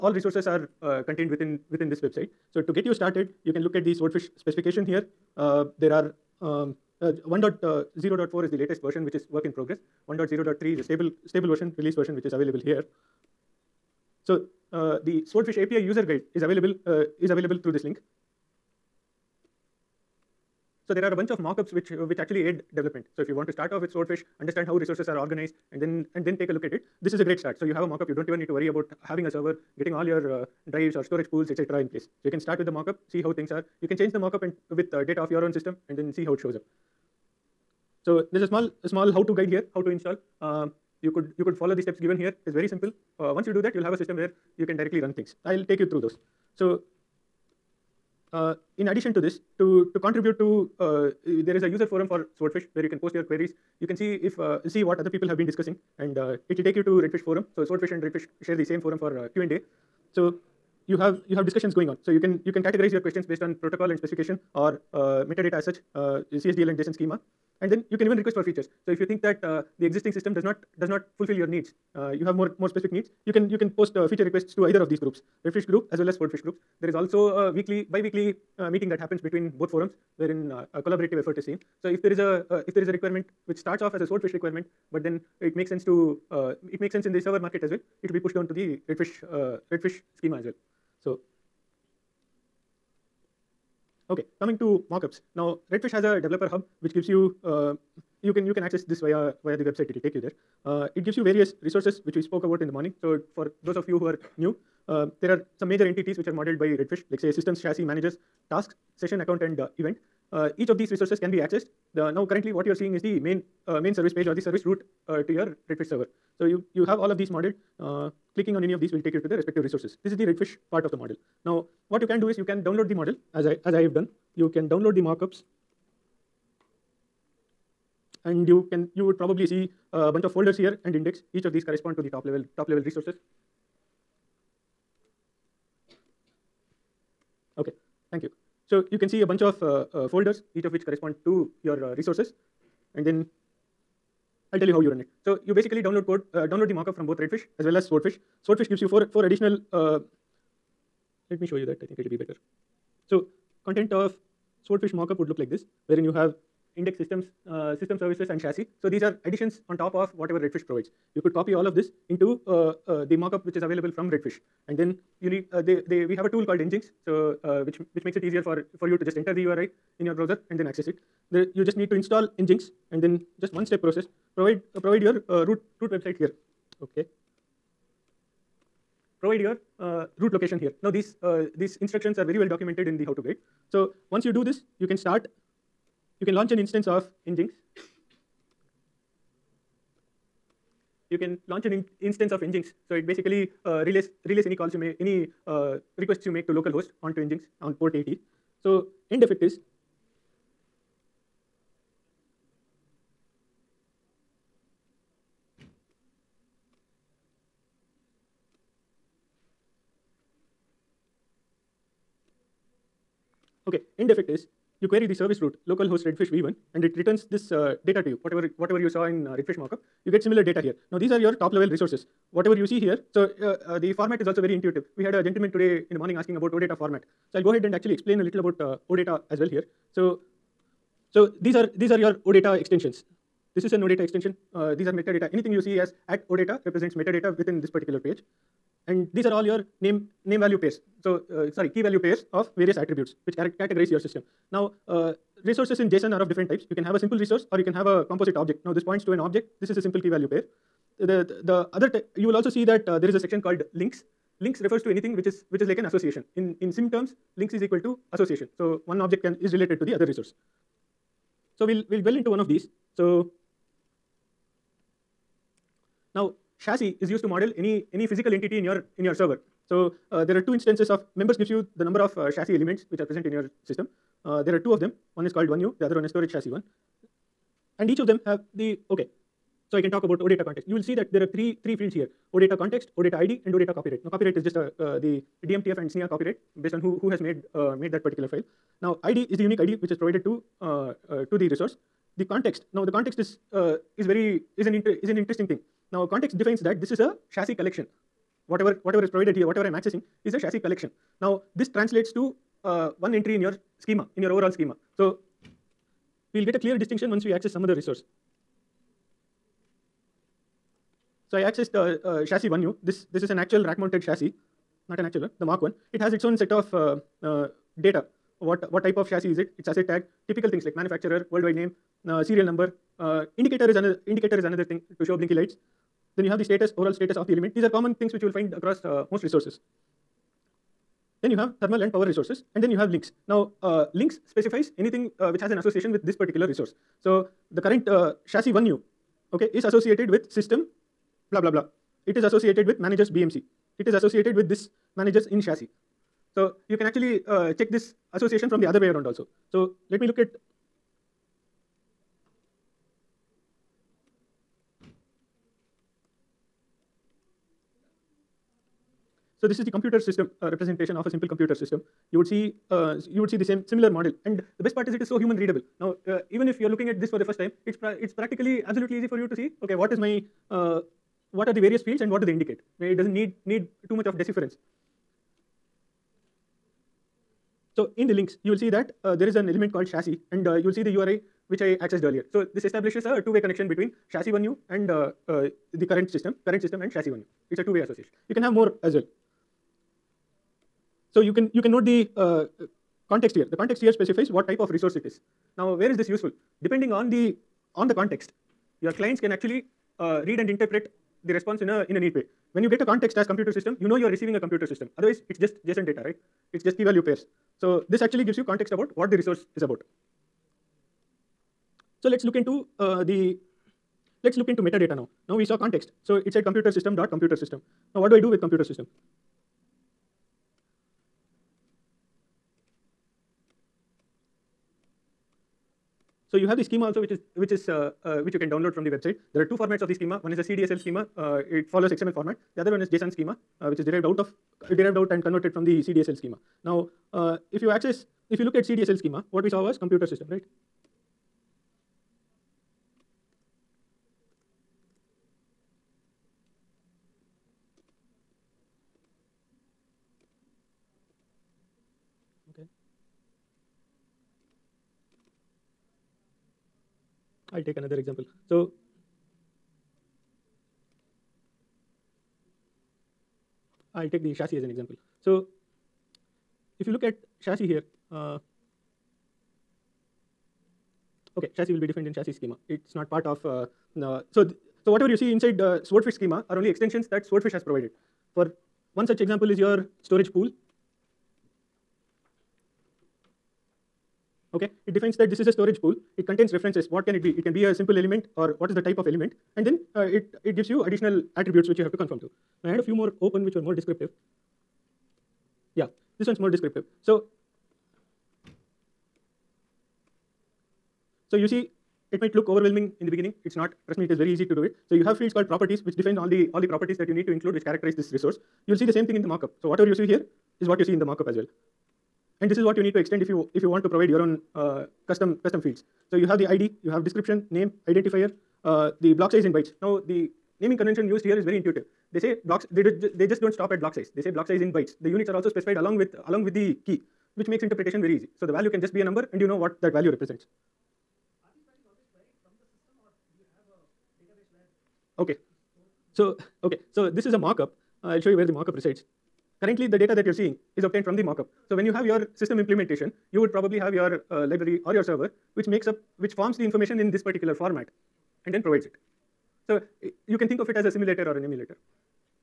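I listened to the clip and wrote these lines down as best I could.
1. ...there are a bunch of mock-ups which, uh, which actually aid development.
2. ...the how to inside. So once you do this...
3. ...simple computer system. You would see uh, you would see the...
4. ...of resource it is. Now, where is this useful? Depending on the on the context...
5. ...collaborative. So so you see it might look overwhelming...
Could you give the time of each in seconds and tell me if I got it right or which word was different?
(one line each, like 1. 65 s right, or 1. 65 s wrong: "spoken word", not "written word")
1. 20 s right
2. 182 s wrong: "guide", not "inside"
3. 361 s right
4. 394 s right
5. 496 s wrong: "descriptive", not "collaborative".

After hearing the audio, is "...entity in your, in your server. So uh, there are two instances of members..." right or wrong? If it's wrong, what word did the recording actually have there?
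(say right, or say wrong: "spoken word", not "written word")
right.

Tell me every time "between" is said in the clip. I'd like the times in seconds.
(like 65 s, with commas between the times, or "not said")
79 s, 383 s.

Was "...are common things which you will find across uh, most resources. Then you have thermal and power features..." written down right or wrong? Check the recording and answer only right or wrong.
wrong.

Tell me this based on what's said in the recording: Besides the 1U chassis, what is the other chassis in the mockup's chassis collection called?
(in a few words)
storage chassis 1.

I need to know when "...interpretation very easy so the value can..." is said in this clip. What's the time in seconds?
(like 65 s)
527 s.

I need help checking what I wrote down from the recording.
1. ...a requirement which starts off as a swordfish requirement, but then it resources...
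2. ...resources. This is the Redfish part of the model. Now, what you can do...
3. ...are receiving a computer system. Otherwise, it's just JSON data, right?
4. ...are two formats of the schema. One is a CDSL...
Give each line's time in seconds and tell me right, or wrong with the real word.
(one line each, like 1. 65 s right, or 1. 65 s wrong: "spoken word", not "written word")
1. 82 s wrong: "makes", not "resources"
2. 119 s right
3. 404 s right
4. 429 s right.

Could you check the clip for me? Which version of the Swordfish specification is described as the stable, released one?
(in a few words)
1.0.3.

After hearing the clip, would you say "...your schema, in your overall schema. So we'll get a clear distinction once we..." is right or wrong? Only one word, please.
right.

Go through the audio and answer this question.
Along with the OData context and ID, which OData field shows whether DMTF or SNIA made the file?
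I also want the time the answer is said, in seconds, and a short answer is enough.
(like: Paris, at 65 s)
OData copyright, at 283 s.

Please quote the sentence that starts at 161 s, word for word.
You could copy all of this into uh, uh, the mockup which is available from Redfish.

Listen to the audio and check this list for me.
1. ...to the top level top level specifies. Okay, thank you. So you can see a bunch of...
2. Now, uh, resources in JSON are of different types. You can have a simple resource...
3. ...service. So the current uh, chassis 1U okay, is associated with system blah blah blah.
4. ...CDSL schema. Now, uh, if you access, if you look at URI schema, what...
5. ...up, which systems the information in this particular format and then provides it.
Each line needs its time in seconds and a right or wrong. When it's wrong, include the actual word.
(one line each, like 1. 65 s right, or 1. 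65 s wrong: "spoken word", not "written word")
1. 131 s wrong: "resources", not "specifies"
2. 244 s right
3. 336 s wrong: "resource", not "service"
4. 435 s wrong: "CDSL", not "URI"
5. 545 s wrong: "forms", not "systems".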